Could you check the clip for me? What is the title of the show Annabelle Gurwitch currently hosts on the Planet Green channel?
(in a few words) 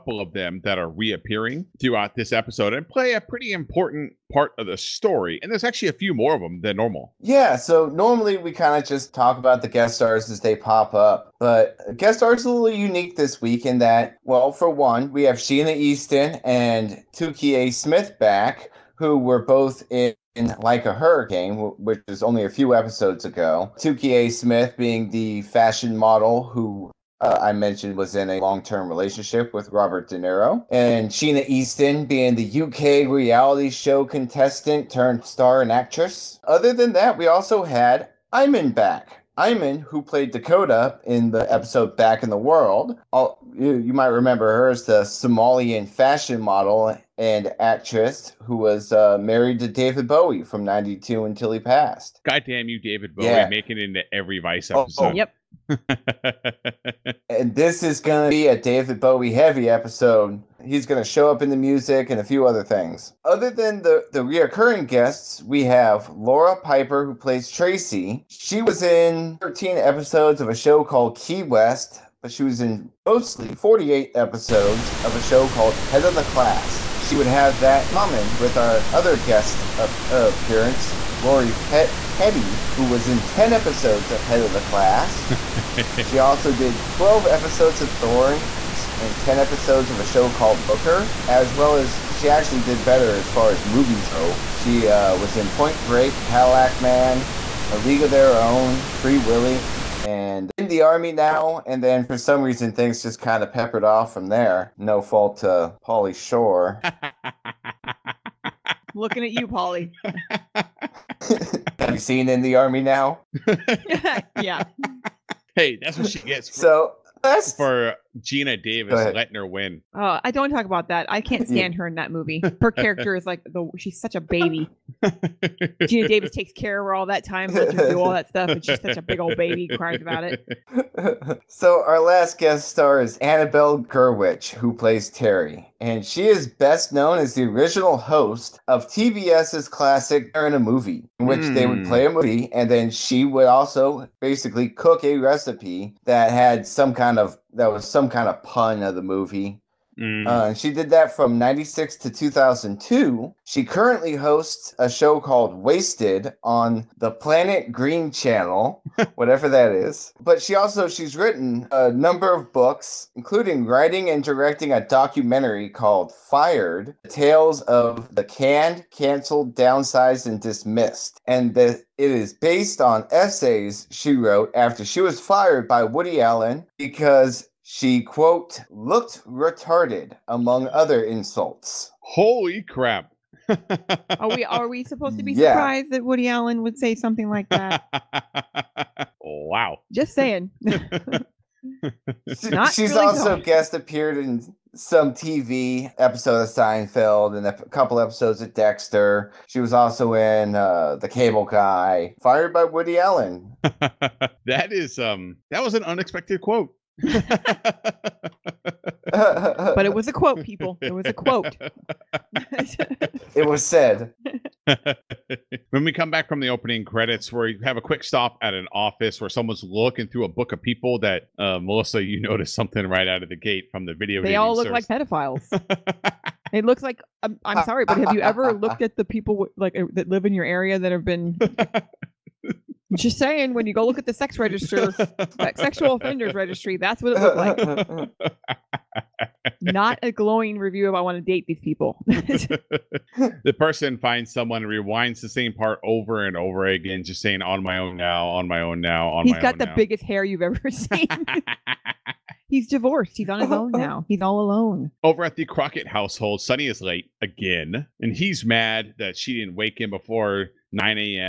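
Wasted.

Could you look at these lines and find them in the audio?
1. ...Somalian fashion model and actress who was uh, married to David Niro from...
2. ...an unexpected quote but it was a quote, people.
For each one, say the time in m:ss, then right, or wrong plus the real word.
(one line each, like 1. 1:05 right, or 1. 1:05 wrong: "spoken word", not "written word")
1. 0:45 wrong: "Bowie", not "Niro"
2. 3:25 right.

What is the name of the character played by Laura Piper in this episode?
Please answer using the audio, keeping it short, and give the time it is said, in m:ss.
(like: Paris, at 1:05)
Tracy, at 1:07.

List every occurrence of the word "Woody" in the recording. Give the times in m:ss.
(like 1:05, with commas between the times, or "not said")
2:55, 3:06, 3:22.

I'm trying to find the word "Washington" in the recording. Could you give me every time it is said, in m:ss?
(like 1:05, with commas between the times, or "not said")
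not said.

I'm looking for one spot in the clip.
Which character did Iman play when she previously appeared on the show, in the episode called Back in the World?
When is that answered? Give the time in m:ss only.
0:40.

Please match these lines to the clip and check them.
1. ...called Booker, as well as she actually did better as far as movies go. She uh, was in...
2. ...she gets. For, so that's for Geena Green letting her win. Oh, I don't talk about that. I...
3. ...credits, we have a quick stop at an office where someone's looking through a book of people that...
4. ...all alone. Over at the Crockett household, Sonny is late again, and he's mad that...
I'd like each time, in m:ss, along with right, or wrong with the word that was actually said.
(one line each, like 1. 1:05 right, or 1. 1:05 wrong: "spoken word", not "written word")
1. 1:30 right
2. 1:56 wrong: "Davis", not "Green"
3. 3:36 right
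4. 4:14 right.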